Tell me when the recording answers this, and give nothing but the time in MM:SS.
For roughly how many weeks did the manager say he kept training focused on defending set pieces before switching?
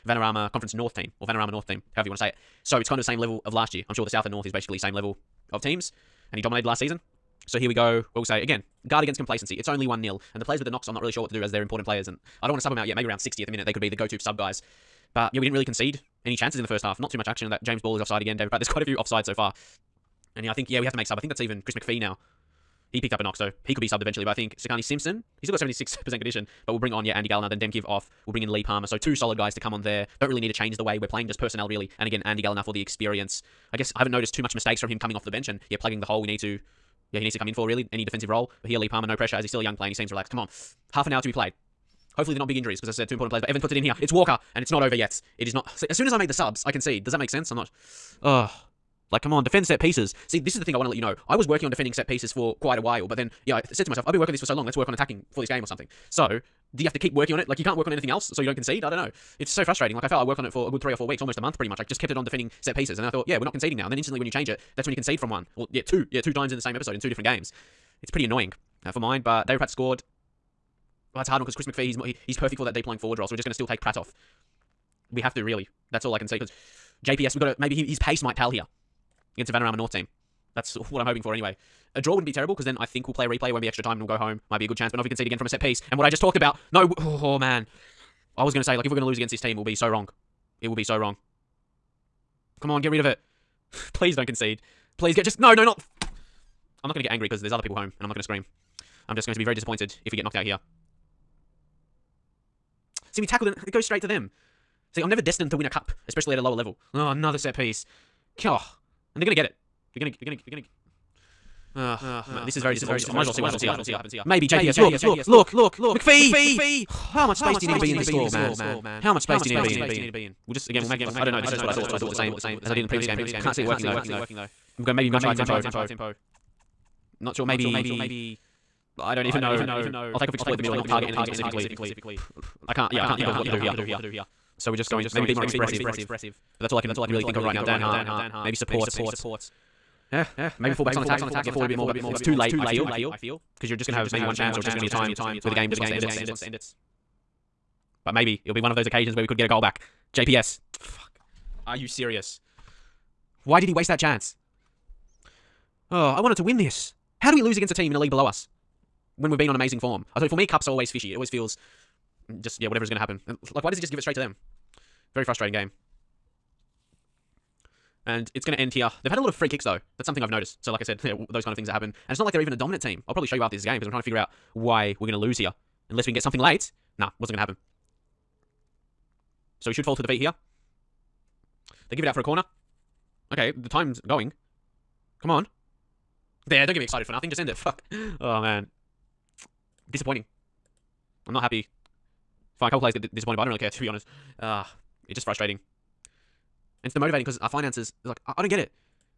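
01:00.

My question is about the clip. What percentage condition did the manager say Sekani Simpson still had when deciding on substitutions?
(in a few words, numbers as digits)
76%.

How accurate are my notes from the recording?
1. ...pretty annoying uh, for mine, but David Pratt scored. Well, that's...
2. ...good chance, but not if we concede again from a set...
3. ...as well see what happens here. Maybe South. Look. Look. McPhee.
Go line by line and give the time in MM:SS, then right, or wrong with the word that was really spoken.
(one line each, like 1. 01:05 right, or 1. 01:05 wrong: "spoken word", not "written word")
1. 01:08 right
2. 01:24 right
3. 01:53 wrong: "JPS", not "South".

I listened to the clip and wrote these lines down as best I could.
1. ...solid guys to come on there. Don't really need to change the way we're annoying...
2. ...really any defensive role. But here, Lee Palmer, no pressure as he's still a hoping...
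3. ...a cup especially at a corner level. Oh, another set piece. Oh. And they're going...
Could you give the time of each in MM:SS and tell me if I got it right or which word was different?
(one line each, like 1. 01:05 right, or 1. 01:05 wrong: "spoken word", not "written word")
1. 00:29 wrong: "playing", not "annoying"
2. 00:37 wrong: "young", not "hoping"
3. 01:45 wrong: "lower", not "corner".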